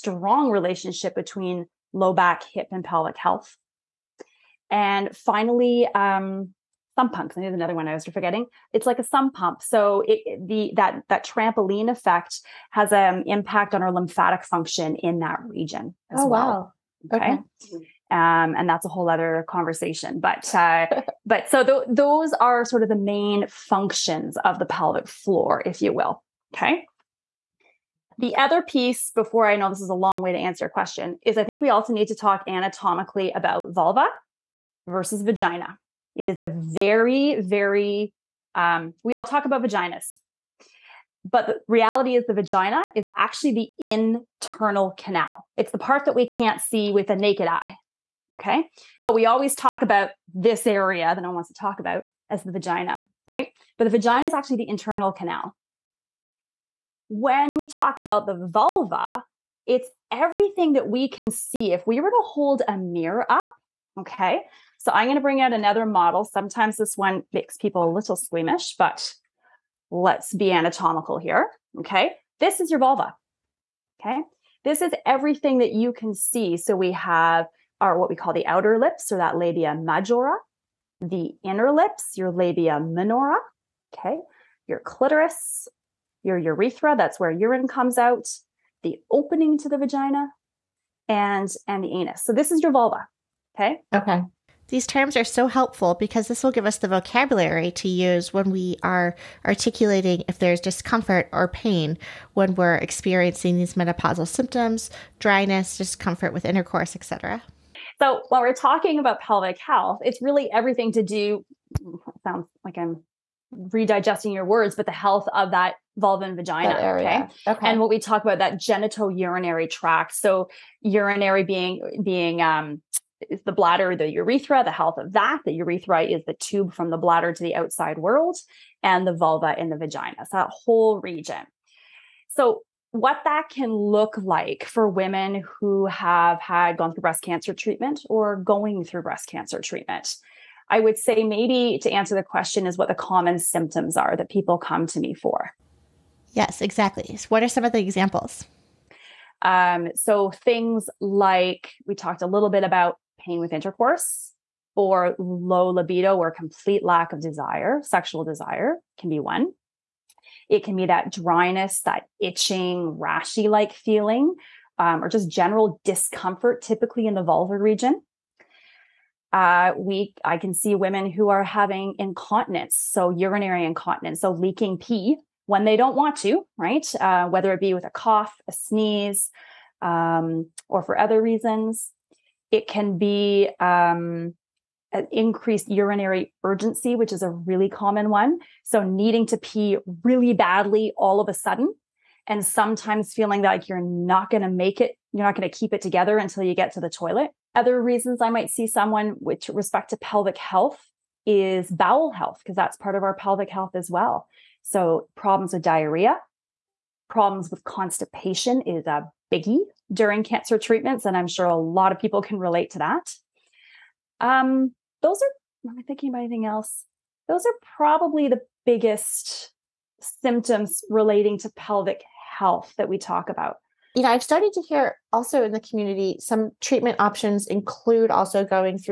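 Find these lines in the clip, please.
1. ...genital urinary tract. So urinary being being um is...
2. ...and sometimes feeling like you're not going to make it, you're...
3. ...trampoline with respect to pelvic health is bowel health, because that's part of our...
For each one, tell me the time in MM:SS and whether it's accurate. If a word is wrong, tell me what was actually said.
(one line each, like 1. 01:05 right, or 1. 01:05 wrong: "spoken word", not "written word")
1. 01:58 right
2. 03:12 right
3. 03:18 wrong: "someone", not "trampoline".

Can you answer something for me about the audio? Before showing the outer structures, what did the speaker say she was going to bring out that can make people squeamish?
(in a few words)
another model.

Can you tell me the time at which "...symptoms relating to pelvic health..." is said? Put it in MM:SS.
03:40.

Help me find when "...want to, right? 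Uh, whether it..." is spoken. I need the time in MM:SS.
02:55.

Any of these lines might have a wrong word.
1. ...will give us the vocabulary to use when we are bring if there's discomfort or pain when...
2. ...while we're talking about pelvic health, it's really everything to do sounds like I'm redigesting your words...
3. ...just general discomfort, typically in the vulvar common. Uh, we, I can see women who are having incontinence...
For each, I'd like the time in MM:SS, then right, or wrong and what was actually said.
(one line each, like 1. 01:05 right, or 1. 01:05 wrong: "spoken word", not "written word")
1. 01:36 wrong: "articulating", not "bring"
2. 01:48 right
3. 02:45 wrong: "region", not "common".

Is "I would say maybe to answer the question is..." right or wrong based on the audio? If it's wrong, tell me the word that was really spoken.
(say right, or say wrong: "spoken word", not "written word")
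right.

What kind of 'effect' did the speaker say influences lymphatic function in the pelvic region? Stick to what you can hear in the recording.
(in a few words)
trampoline effect.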